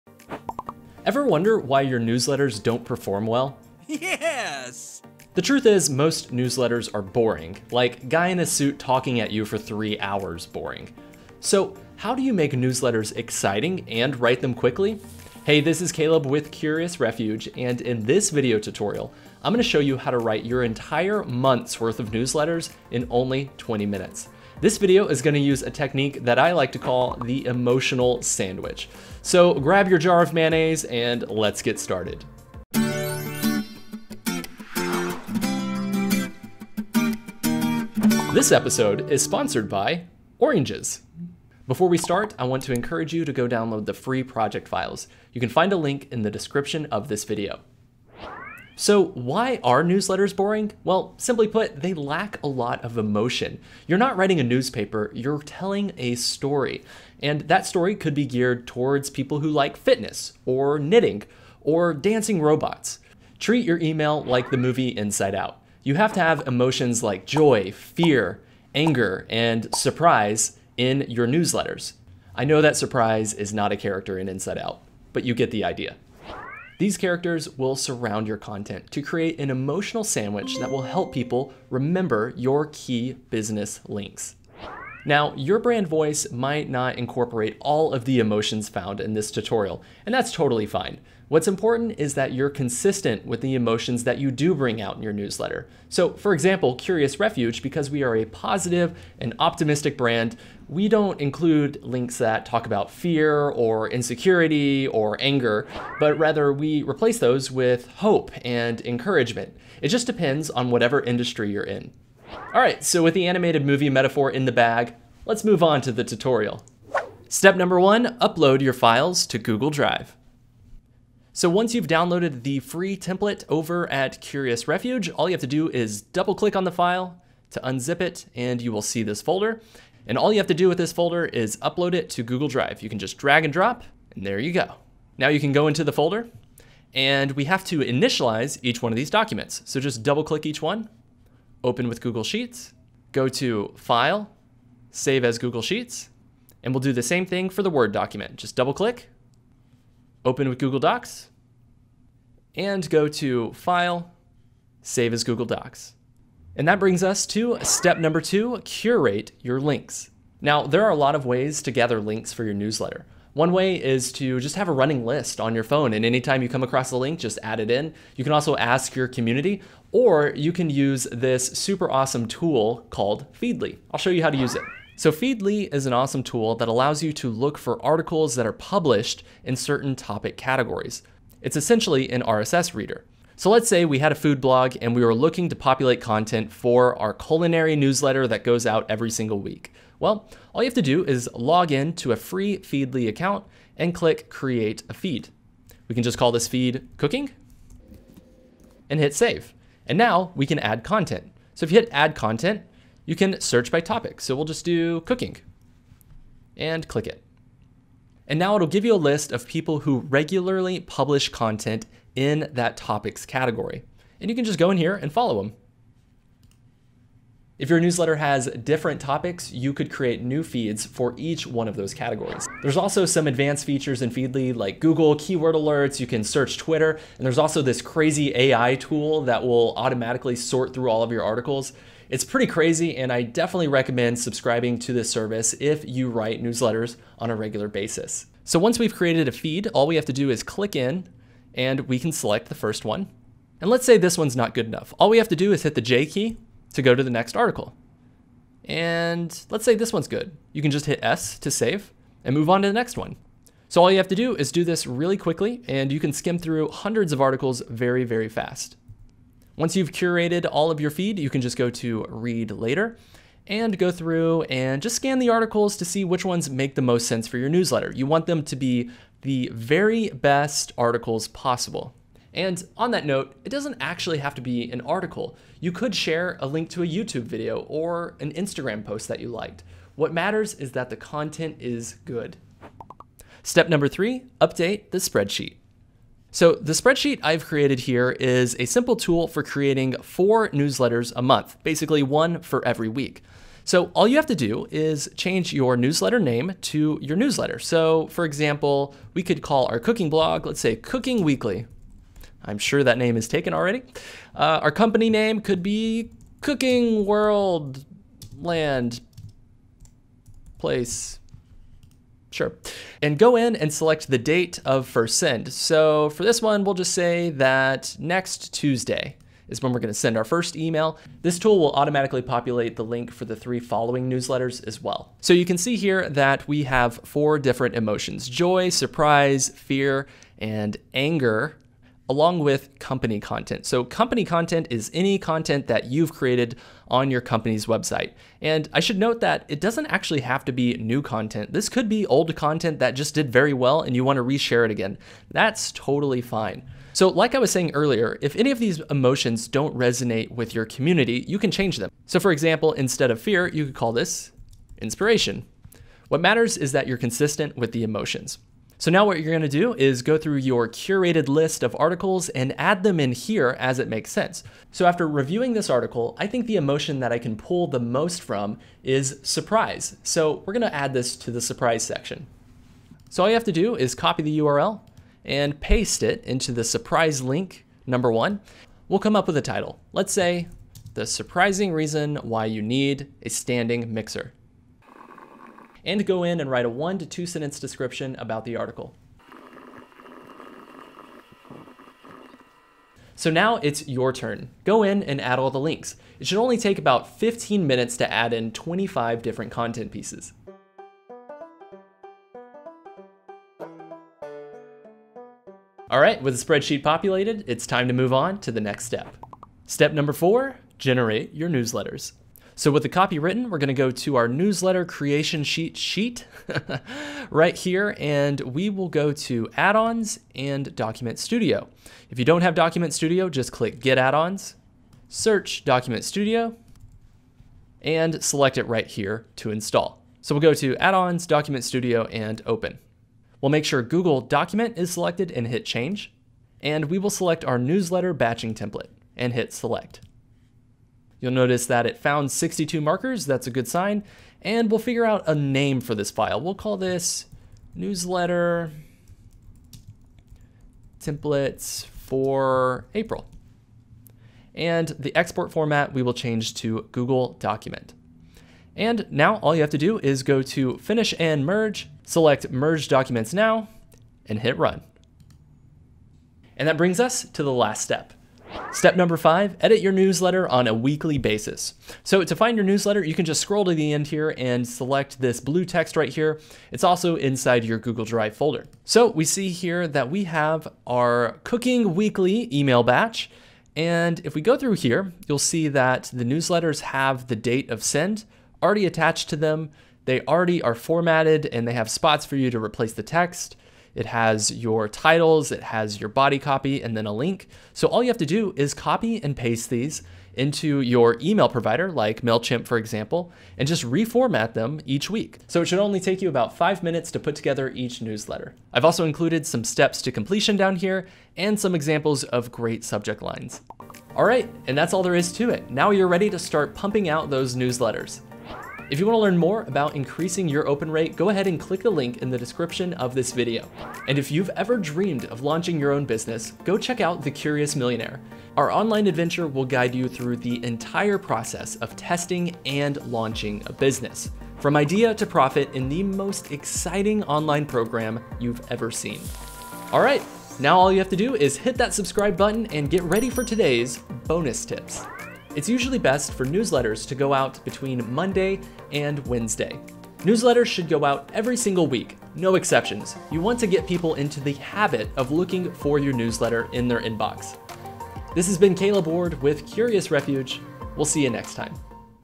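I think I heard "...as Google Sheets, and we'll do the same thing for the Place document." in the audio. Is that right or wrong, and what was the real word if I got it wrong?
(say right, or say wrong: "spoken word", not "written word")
wrong: "Word", not "Place".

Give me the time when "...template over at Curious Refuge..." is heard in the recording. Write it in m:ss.
2:02.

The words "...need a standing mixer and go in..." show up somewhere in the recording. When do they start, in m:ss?
6:22.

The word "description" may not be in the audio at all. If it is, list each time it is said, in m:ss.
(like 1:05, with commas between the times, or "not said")
0:46, 6:27, 8:42.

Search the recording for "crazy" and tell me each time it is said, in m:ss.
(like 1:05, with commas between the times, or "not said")
3:47, 3:52.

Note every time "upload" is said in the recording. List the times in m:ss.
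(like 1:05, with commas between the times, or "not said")
1:58, 2:11.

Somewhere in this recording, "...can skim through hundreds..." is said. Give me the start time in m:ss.
4:15.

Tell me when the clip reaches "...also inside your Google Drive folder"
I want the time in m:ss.
7:56.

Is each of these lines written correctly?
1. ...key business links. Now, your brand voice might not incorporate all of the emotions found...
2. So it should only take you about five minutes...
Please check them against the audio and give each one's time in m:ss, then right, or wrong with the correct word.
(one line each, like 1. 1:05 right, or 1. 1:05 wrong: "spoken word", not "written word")
1. 1:22 right
2. 8:25 right.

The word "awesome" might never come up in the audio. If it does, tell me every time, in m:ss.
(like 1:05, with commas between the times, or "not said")
2:51, 2:55.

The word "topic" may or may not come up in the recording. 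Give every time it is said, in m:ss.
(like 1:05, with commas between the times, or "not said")
2:59, 3:23, 3:32, 3:38.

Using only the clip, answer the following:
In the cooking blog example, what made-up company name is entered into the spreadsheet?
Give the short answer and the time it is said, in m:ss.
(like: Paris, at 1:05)
Cooking World Land Place, at 5:06.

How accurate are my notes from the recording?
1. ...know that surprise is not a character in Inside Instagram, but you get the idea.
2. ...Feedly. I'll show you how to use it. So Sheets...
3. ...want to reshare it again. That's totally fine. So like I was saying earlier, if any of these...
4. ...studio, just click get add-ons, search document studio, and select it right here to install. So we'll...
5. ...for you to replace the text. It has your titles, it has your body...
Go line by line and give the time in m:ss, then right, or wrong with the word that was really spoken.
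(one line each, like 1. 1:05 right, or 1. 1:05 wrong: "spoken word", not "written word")
1. 1:12 wrong: "Out", not "Instagram"
2. 2:53 wrong: "Feedly", not "Sheets"
3. 5:44 right
4. 7:02 right
5. 8:12 right.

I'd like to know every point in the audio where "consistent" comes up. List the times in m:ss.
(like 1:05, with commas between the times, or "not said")
1:32, 5:56.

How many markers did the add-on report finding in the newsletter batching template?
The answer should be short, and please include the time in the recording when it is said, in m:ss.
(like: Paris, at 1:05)
62, at 7:22.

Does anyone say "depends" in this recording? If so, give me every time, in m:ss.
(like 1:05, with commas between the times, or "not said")
1:50.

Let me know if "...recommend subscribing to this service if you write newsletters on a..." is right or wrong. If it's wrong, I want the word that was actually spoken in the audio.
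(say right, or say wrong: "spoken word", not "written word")
right.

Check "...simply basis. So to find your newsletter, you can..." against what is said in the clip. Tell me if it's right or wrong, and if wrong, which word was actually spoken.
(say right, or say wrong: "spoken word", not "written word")
wrong: "weekly", not "simply".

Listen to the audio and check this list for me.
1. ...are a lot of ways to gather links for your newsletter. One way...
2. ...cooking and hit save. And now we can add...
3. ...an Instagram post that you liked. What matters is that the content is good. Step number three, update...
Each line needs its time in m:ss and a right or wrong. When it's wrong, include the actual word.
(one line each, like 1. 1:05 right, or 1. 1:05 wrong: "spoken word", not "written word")
1. 2:40 right
2. 3:16 right
3. 4:38 right.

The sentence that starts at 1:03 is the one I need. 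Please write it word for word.
Treat your email like the movie Inside Out.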